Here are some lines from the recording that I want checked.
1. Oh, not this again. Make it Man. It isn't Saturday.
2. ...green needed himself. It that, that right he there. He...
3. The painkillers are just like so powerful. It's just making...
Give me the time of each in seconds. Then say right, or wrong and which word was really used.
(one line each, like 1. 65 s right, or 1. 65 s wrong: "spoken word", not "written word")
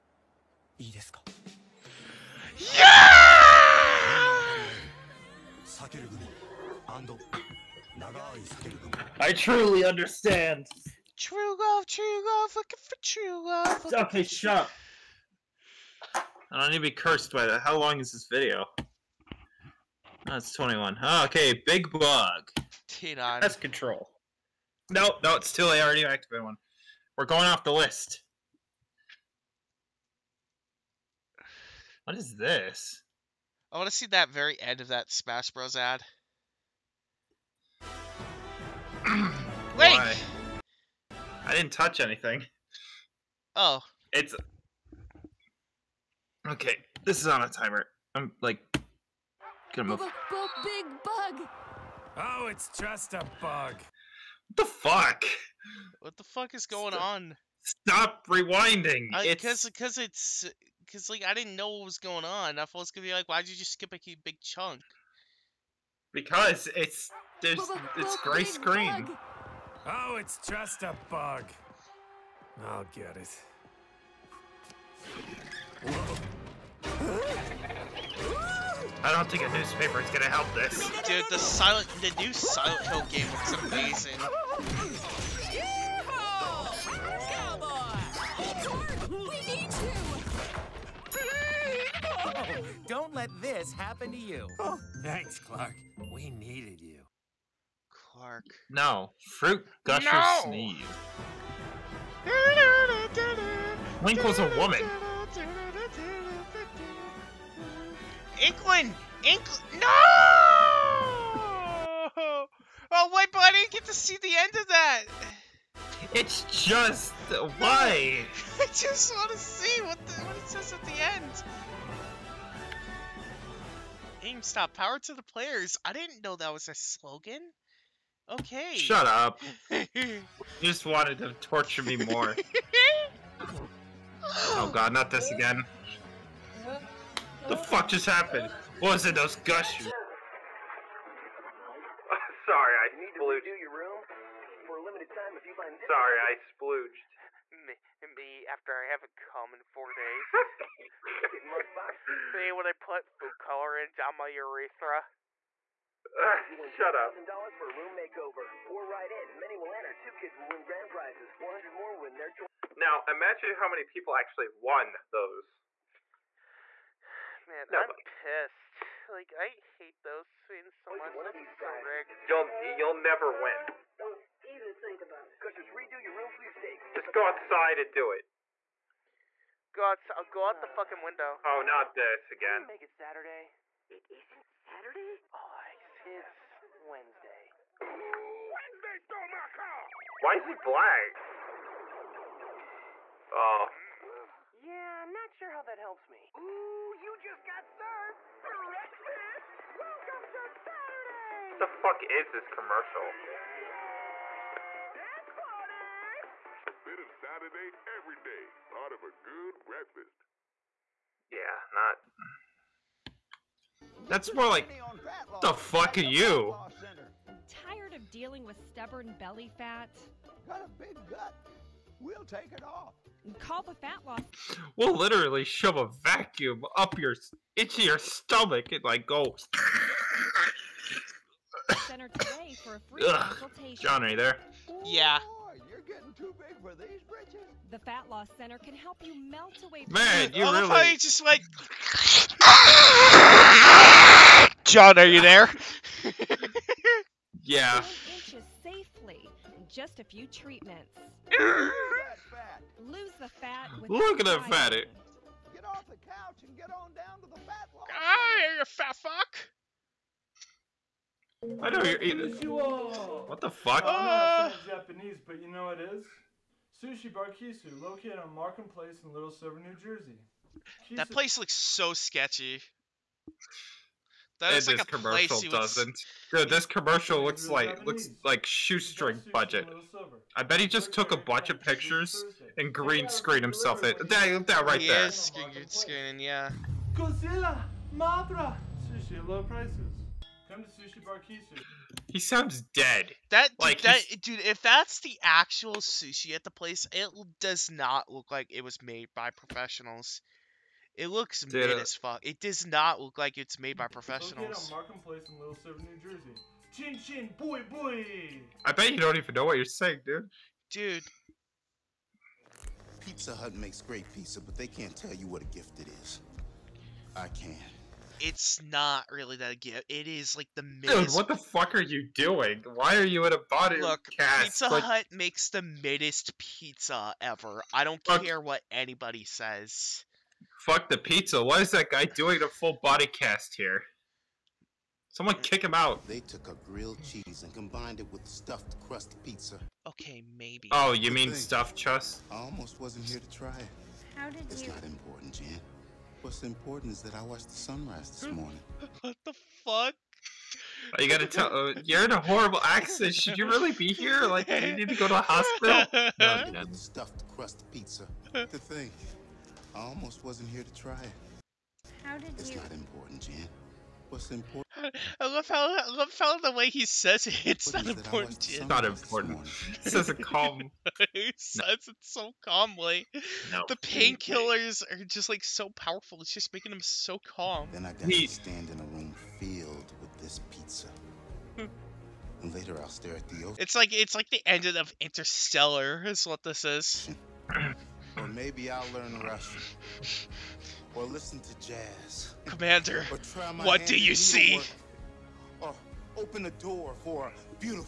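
1. 181 s wrong: "Saturday", not "Man"
2. 282 s wrong: "screened", not "needed"
3. 373 s right.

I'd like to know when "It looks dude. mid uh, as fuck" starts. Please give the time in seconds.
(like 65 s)
300 s.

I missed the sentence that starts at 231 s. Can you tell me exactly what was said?
Center today for a free Ugh.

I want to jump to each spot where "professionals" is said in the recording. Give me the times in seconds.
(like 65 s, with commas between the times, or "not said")
299 s, 303 s.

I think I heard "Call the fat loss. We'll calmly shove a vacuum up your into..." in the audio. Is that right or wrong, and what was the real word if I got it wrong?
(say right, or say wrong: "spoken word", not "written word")
wrong: "literally", not "calmly".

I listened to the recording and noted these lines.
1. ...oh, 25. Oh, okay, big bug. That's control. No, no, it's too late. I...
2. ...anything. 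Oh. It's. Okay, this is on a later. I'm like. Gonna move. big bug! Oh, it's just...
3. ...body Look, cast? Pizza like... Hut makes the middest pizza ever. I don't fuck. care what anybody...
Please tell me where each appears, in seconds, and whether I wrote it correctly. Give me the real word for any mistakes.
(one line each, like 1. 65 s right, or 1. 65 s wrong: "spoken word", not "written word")
1. 20 s wrong: "21", not "25"
2. 41 s wrong: "timer", not "later"
3. 323 s right.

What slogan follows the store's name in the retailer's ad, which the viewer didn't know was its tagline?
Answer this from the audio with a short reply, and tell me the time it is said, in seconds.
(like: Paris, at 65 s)
Power to the players, at 124 s.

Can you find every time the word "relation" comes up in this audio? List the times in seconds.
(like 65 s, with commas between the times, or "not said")
not said.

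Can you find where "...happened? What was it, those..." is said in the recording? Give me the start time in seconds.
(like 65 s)
138 s.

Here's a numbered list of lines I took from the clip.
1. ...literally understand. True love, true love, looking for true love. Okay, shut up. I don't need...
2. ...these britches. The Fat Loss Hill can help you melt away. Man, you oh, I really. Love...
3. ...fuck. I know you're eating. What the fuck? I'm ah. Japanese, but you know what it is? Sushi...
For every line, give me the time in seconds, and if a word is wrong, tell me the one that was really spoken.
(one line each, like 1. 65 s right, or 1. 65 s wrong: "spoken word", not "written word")
1. 9 s wrong: "truly", not "literally"
2. 236 s wrong: "Center", not "Hill"
3. 258 s right.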